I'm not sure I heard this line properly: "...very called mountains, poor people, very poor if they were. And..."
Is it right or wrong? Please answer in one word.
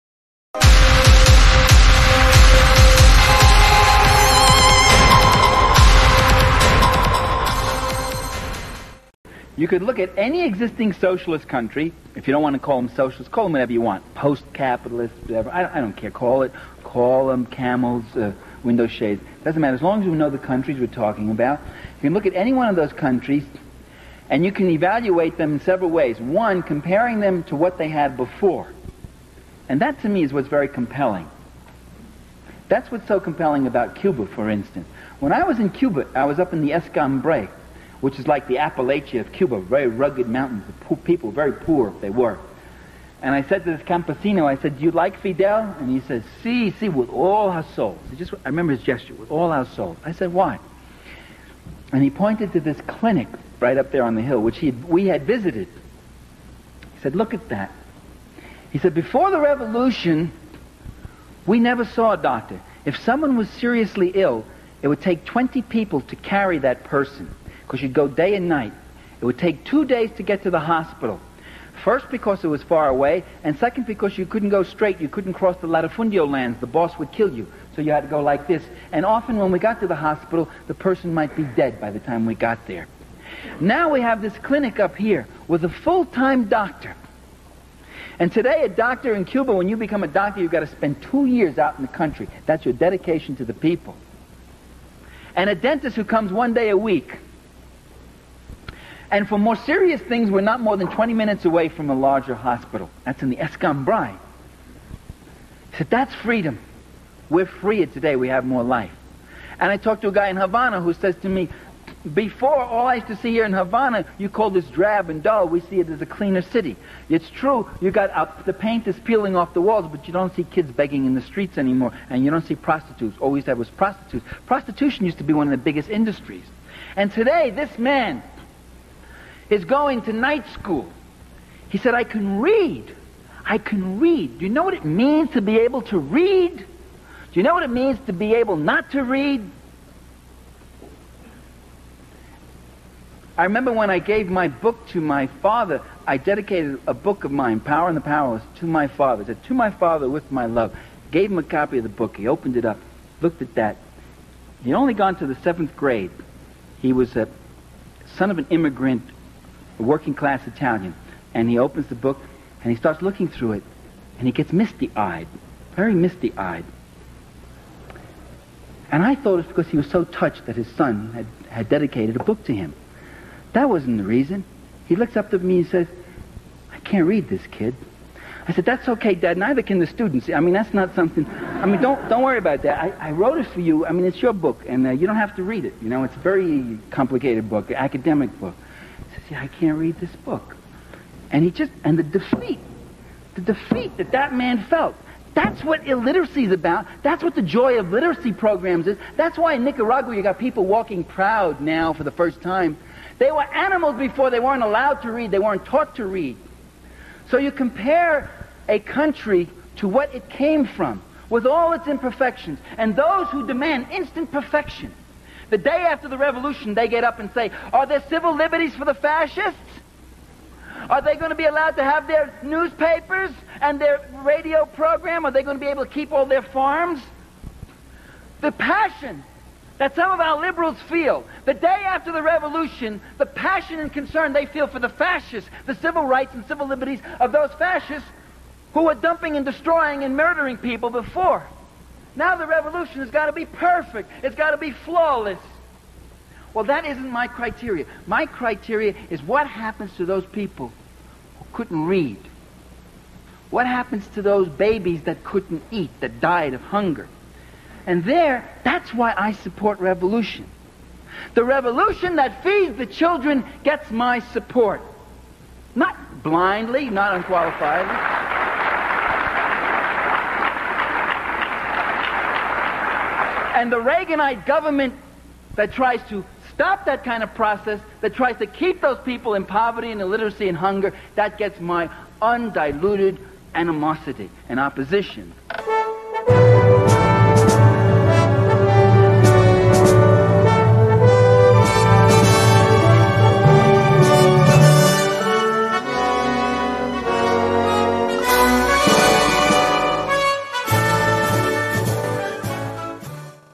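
wrong.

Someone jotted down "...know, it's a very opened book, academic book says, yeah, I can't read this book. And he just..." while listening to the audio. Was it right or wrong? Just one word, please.
wrong.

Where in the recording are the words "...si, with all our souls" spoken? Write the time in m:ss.
0:46.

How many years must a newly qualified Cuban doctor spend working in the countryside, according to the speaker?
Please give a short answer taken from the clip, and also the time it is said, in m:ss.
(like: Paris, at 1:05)
2 years, at 1:31.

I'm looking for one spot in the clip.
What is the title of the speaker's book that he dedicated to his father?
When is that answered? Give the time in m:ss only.
2:27.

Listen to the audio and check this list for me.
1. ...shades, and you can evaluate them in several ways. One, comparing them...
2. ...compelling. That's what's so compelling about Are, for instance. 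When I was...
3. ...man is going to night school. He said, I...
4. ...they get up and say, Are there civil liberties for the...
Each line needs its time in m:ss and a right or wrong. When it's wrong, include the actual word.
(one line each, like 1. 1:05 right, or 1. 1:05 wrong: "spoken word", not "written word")
1. 0:22 wrong: "countries", not "shades"
2. 0:30 wrong: "Cuba", not "Are"
3. 2:07 right
4. 3:36 right.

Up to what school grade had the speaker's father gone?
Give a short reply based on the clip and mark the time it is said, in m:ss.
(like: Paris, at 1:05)
Seventh grade, at 2:35.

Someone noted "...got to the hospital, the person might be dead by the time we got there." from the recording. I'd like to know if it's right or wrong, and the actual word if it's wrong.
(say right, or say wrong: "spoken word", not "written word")
right.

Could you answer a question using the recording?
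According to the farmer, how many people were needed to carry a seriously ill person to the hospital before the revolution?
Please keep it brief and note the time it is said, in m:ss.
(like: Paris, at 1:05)
20, at 1:05.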